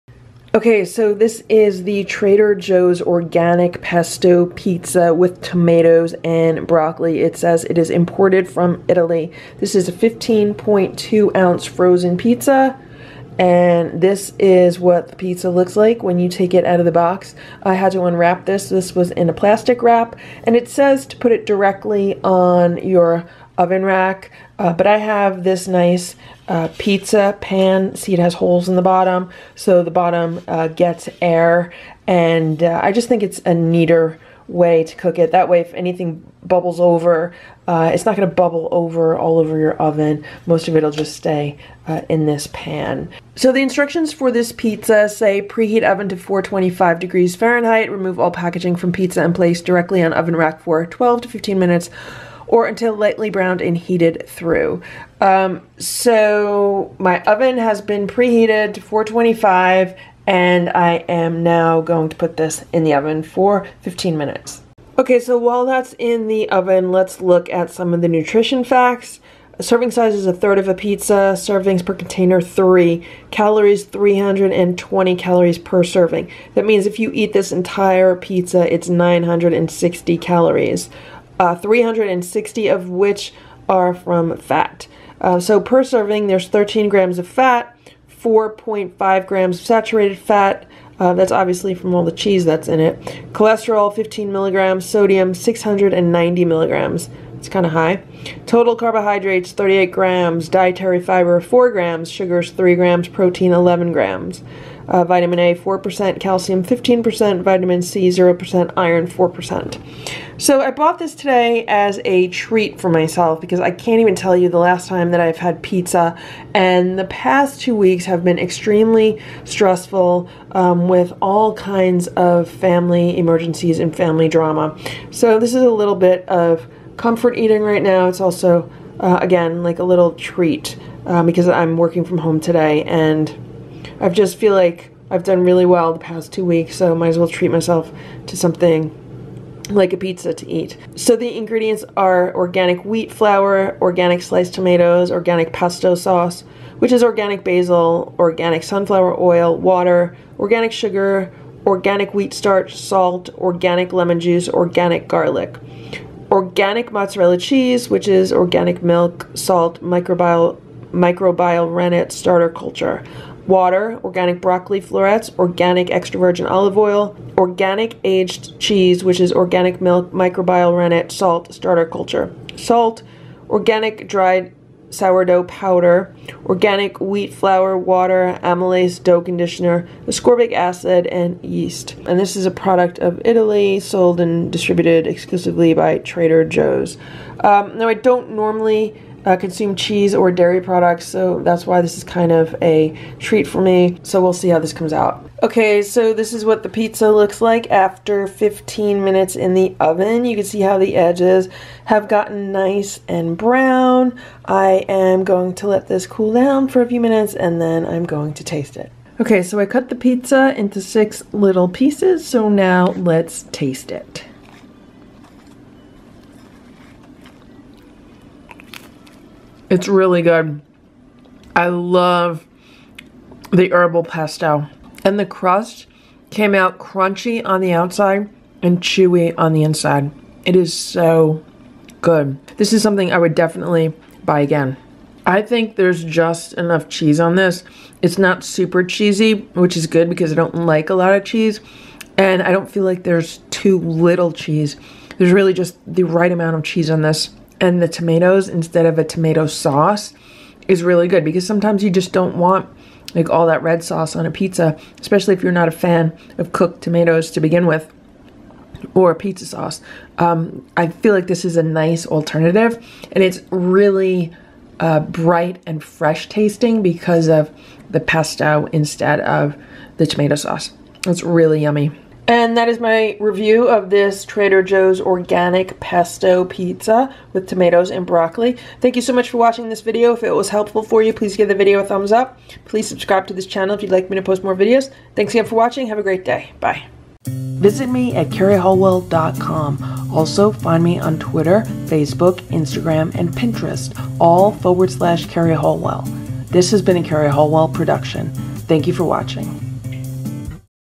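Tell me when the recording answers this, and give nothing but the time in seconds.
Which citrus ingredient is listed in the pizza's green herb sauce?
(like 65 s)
153 s.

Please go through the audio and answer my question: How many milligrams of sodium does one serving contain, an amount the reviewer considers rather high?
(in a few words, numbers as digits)
690 milligrams.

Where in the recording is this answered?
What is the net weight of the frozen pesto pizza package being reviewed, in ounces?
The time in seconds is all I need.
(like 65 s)
9 s.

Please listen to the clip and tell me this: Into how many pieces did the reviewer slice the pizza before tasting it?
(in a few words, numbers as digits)
6.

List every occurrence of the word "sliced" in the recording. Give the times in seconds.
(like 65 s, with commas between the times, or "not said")
144 s.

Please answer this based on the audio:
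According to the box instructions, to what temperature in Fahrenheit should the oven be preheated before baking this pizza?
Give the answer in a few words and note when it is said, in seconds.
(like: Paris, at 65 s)
425 degrees, at 46 s.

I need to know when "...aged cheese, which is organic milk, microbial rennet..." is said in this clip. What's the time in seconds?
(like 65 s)
168 s.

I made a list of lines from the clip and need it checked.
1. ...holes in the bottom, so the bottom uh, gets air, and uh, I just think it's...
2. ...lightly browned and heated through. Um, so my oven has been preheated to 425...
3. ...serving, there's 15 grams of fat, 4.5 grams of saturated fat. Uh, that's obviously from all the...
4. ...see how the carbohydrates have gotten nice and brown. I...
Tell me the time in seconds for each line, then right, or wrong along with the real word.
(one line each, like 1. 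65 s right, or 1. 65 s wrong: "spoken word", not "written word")
1. 28 s right
2. 52 s right
3. 85 s wrong: "13", not "15"
4. 200 s wrong: "edges", not "carbohydrates".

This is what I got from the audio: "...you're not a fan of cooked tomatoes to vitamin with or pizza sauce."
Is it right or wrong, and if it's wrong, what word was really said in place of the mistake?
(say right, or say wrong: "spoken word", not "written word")
wrong: "begin", not "vitamin".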